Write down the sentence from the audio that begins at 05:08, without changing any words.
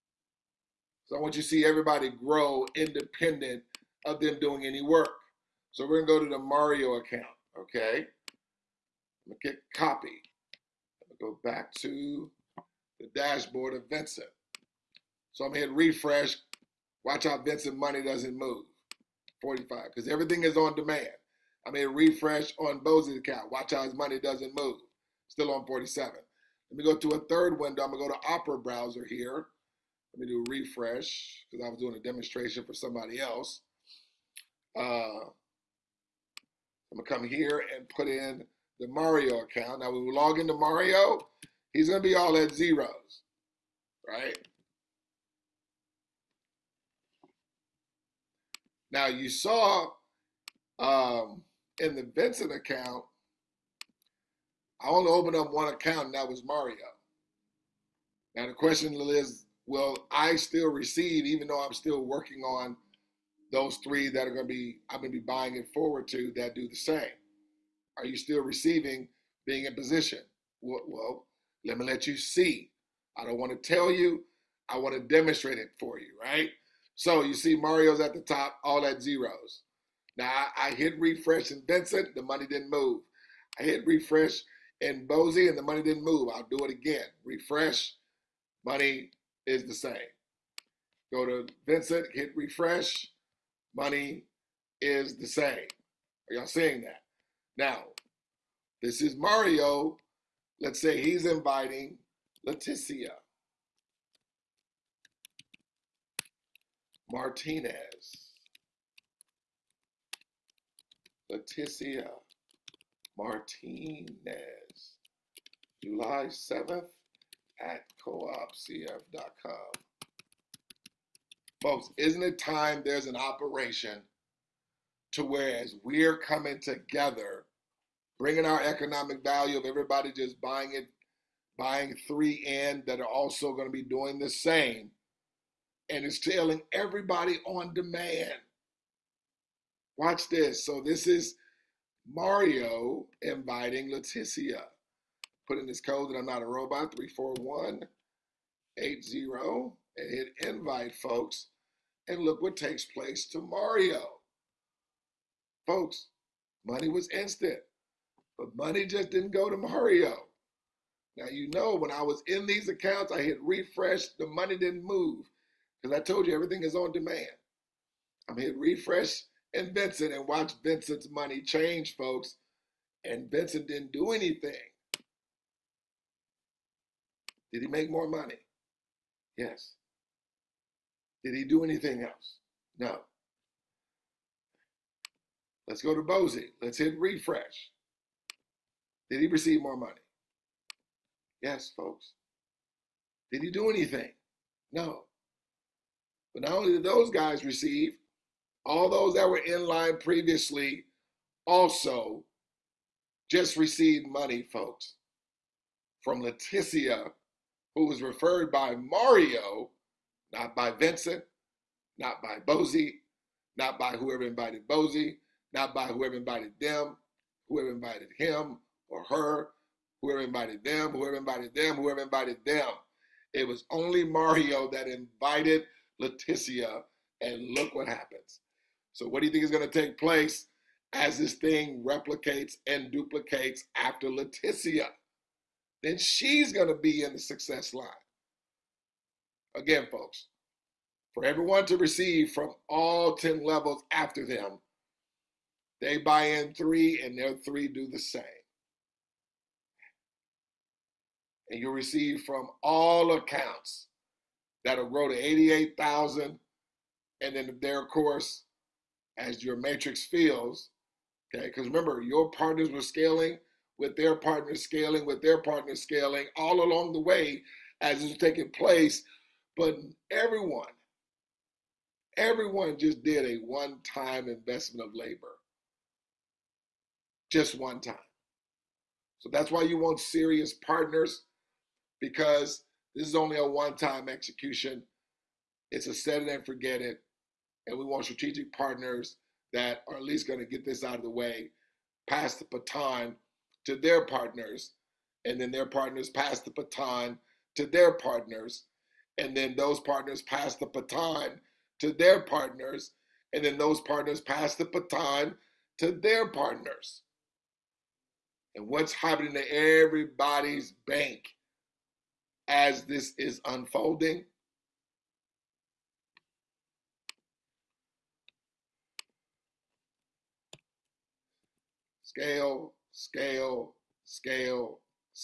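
And what's happening to everybody's bank as this is unfolding?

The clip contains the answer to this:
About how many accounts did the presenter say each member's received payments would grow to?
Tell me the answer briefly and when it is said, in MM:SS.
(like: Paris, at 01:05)
88,000, at 04:15.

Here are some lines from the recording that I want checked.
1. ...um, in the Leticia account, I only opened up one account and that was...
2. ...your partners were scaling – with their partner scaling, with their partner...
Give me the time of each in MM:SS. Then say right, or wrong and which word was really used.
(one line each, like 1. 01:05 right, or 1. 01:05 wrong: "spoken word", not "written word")
1. 00:50 wrong: "Vincent", not "Leticia"
2. 04:22 right.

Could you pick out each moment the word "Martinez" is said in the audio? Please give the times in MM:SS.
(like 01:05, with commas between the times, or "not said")
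01:47, 01:53.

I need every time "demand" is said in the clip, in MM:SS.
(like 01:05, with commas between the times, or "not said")
00:20, 02:17, 02:46.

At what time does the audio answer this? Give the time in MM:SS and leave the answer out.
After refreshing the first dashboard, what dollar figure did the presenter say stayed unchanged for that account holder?
00:19.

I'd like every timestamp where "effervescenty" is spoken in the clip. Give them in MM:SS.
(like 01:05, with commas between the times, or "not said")
not said.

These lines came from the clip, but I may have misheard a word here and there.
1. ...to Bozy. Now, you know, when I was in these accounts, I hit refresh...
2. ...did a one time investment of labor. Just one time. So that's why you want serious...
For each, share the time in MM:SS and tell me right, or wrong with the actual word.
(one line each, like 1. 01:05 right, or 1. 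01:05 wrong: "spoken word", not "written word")
1. 02:39 wrong: "Mario", not "Bozy"
2. 04:33 right.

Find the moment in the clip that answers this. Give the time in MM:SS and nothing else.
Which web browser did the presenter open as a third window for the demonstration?
00:28.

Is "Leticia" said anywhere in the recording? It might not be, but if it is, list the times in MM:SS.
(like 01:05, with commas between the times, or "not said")
01:42, 01:51, 02:23, 03:26, 03:46, 03:54.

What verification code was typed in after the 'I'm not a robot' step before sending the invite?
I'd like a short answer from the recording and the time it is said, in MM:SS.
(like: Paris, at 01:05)
34180, at 02:26.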